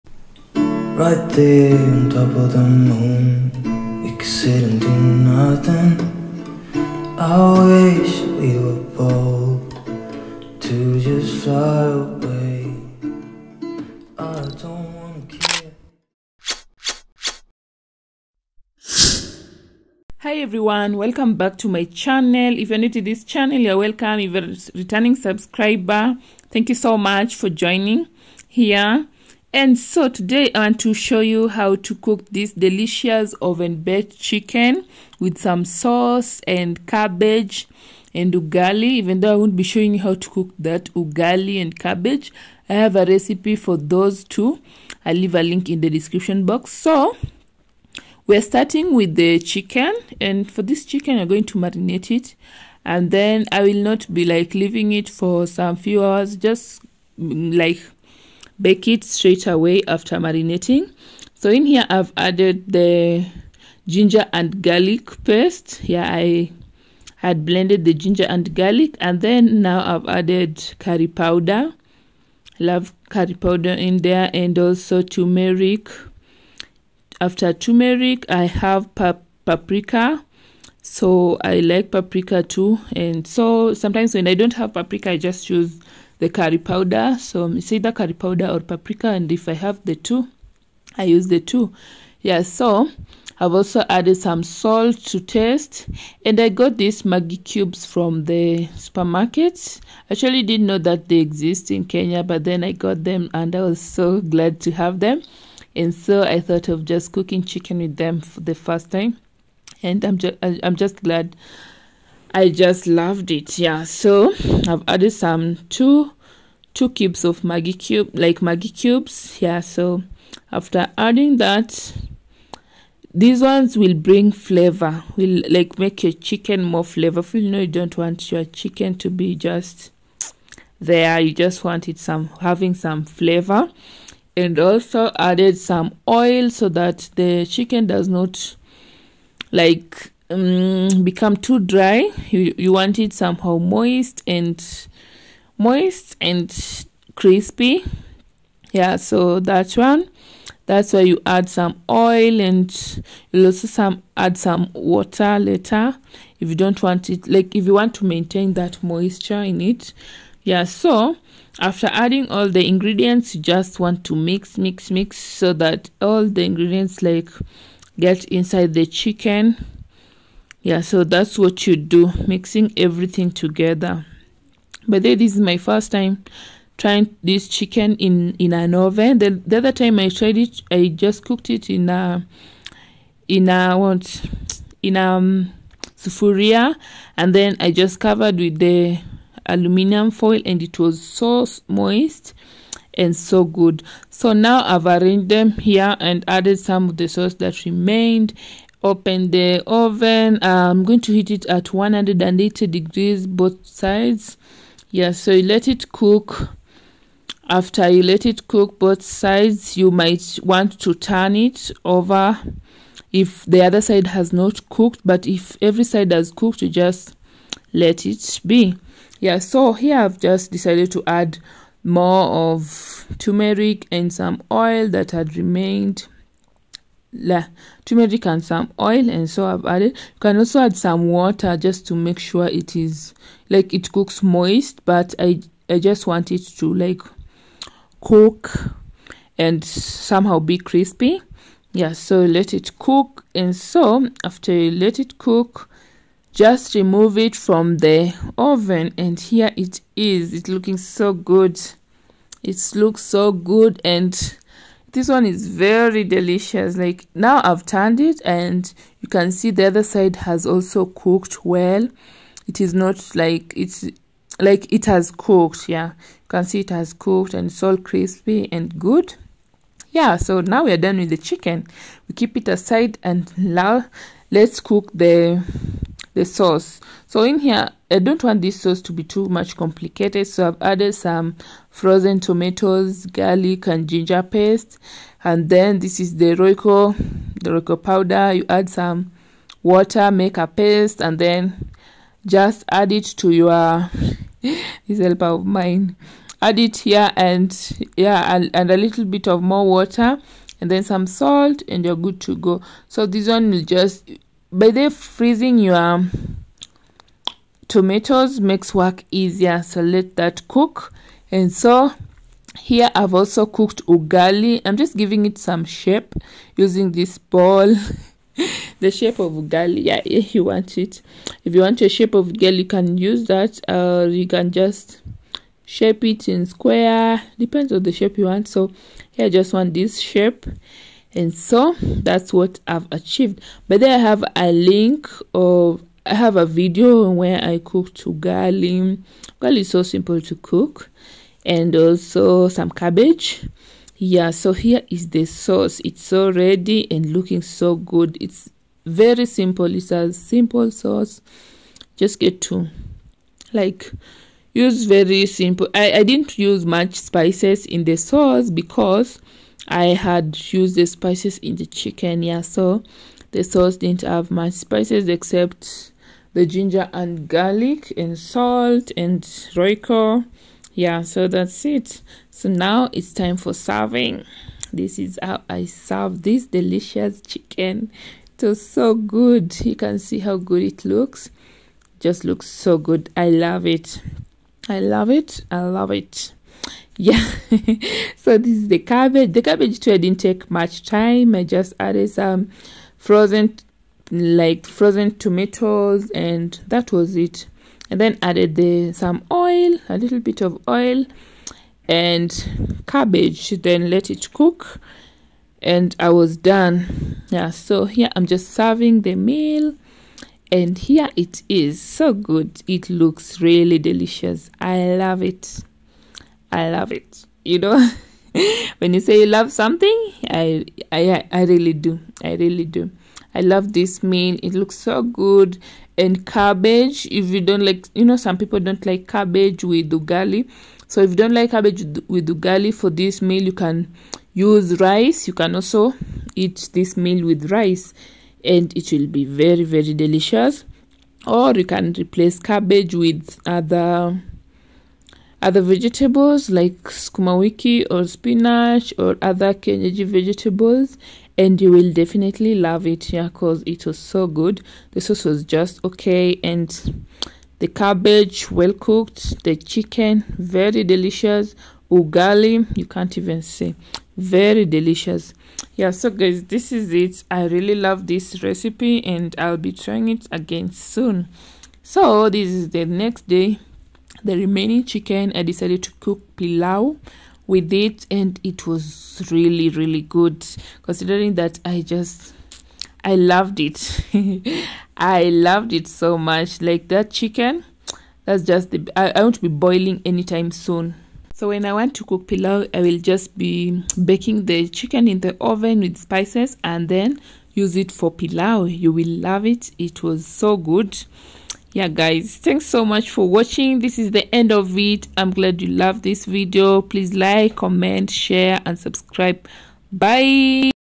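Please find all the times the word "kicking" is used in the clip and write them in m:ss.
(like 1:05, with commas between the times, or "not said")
not said.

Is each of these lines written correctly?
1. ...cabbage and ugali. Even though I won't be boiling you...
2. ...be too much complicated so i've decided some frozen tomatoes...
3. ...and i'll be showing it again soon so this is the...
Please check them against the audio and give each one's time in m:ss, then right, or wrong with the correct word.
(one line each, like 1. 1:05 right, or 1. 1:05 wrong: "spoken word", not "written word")
1. 0:36 wrong: "showing", not "boiling"
2. 4:38 wrong: "added", not "decided"
3. 7:49 wrong: "trying", not "showing".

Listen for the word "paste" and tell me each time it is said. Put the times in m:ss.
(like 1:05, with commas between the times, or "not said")
1:05, 4:44, 4:50.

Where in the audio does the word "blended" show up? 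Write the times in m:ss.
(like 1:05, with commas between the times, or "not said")
1:07.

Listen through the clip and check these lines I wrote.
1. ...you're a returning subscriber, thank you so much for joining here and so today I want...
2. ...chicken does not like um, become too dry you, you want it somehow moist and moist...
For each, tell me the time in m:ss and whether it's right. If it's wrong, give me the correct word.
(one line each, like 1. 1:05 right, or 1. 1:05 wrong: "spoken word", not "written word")
1. 0:24 right
2. 2:17 right.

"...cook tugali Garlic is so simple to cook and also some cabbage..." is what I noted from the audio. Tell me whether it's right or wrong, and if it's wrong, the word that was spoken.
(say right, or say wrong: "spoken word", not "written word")
right.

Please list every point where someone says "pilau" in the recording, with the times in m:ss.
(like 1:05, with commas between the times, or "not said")
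7:56, 8:12, 8:18.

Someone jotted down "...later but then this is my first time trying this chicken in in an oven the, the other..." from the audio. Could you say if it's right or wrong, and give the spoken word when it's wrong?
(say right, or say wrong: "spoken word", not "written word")
wrong: "together", not "later".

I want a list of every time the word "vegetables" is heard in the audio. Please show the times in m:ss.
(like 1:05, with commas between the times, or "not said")
7:25, 7:30.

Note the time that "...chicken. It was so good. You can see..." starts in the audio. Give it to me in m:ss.
6:17.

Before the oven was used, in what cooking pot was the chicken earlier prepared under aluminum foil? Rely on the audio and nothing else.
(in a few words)
Sufuria.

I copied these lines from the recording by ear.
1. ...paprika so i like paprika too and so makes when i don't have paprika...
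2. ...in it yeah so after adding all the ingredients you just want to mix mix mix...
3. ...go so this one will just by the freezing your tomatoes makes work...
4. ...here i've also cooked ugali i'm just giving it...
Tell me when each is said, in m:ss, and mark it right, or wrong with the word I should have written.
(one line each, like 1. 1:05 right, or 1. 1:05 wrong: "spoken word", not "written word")
1. 1:19 wrong: "sometimes", not "makes"
2. 2:39 right
3. 5:02 right
4. 5:12 right.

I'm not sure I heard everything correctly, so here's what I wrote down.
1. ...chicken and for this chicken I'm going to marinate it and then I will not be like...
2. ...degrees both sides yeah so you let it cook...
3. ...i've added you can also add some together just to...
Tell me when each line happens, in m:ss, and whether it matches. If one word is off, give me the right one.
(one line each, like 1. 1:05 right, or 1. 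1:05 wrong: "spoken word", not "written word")
1. 0:49 right
2. 3:22 right
3. 3:49 wrong: "water", not "together".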